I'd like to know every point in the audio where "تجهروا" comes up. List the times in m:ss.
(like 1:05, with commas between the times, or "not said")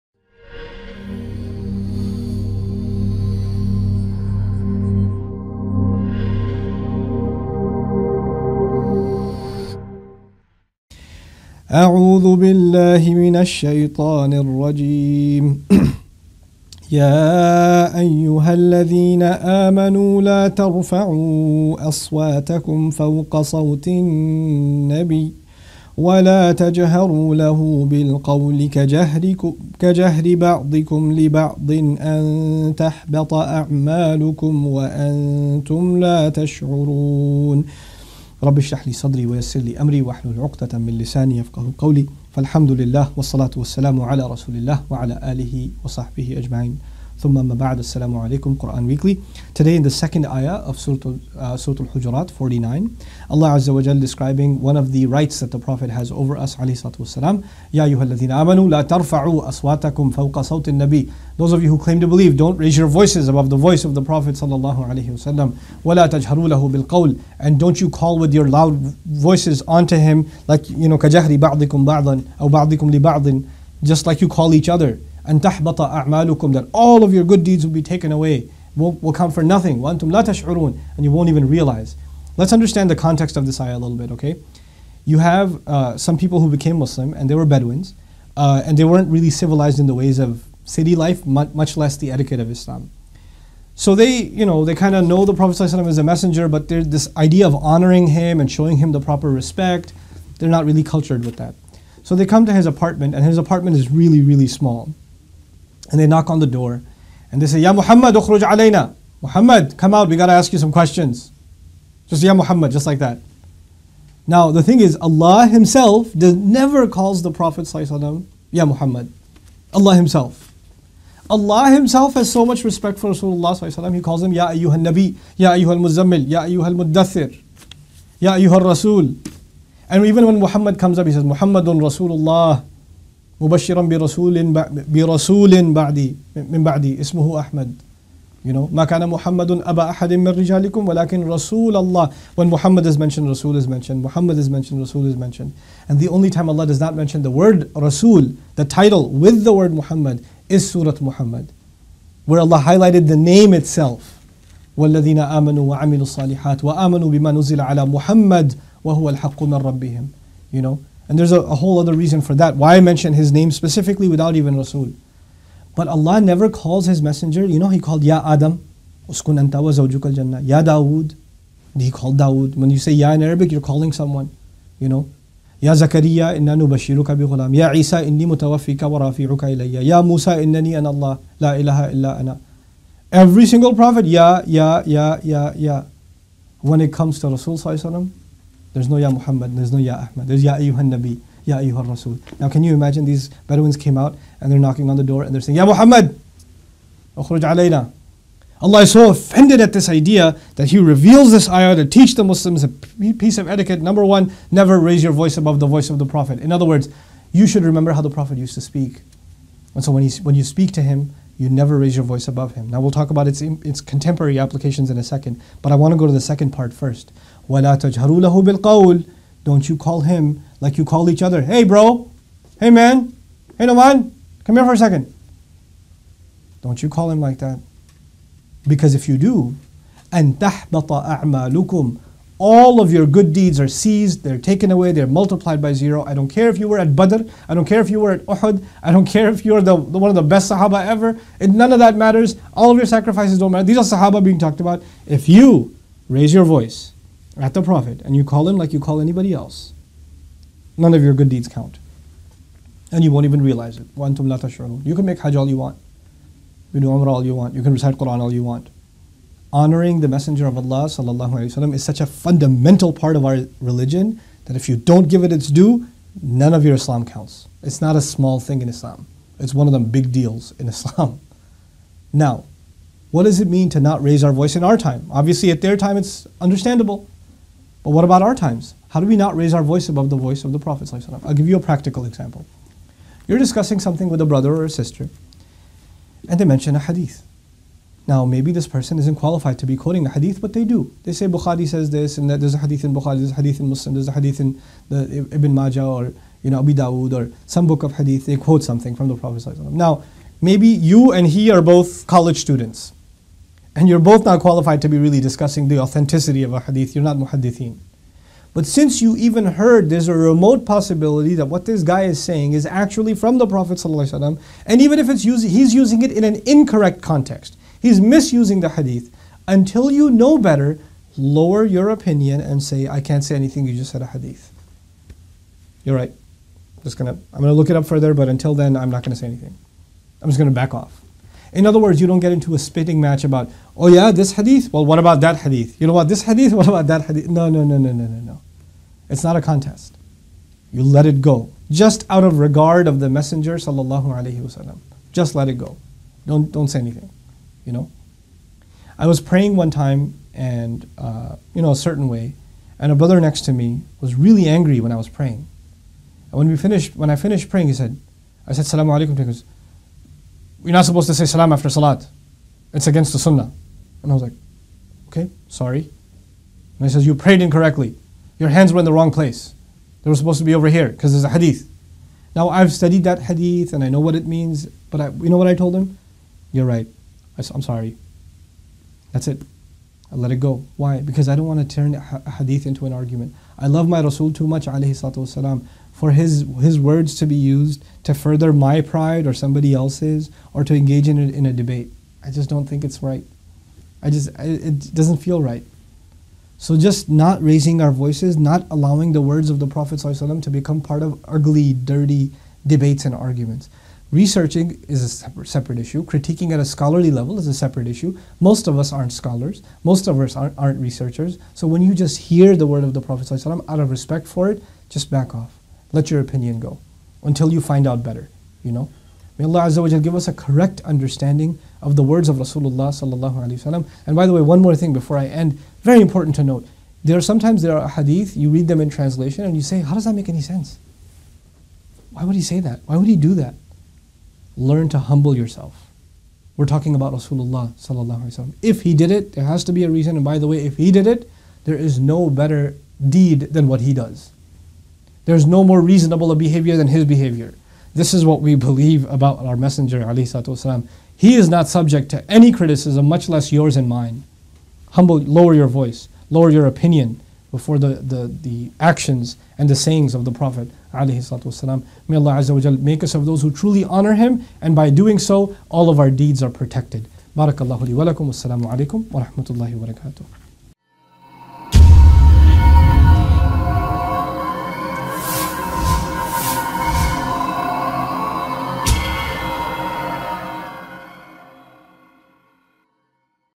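0:26, 1:06.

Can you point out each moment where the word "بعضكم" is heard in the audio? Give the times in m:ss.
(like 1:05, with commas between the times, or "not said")
0:30.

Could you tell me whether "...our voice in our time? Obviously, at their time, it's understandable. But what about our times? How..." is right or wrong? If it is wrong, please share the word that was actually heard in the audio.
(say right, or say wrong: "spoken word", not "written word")
right.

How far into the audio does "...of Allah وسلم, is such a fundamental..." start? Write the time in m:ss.
4:20.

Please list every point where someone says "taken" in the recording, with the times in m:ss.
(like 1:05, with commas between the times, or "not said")
1:17, 3:54.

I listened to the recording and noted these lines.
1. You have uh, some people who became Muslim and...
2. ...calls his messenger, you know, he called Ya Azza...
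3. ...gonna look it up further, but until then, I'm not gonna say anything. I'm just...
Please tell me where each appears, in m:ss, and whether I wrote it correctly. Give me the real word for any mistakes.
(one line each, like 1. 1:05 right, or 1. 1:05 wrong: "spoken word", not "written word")
1. 1:25 right
2. 2:46 wrong: "Adam", not "Azza"
3. 5:27 right.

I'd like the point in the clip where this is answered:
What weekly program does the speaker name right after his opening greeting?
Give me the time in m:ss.
0:48.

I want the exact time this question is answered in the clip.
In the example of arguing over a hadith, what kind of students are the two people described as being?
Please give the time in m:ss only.
5:02.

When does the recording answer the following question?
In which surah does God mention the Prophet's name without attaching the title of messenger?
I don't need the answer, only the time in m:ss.
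2:30.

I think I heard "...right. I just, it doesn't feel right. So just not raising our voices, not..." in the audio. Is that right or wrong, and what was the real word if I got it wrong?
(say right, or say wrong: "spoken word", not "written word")
right.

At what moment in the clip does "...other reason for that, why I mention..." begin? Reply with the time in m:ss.
2:41.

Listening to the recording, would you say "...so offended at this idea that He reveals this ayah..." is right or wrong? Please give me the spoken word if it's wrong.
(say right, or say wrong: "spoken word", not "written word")
right.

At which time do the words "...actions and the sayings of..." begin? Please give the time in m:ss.
7:38.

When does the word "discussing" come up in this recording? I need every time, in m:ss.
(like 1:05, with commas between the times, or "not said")
4:43, 5:05.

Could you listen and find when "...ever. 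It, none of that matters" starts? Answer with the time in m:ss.
4:00.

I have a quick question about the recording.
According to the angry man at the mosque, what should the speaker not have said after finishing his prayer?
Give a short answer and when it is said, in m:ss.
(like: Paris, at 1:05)
Salaam alaikum, at 5:58.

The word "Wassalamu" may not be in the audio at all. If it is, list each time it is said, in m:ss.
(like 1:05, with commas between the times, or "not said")
7:48.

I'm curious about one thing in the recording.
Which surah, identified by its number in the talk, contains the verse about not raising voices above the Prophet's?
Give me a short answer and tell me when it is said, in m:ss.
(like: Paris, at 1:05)
Surah Al-Hujurat, at 0:51.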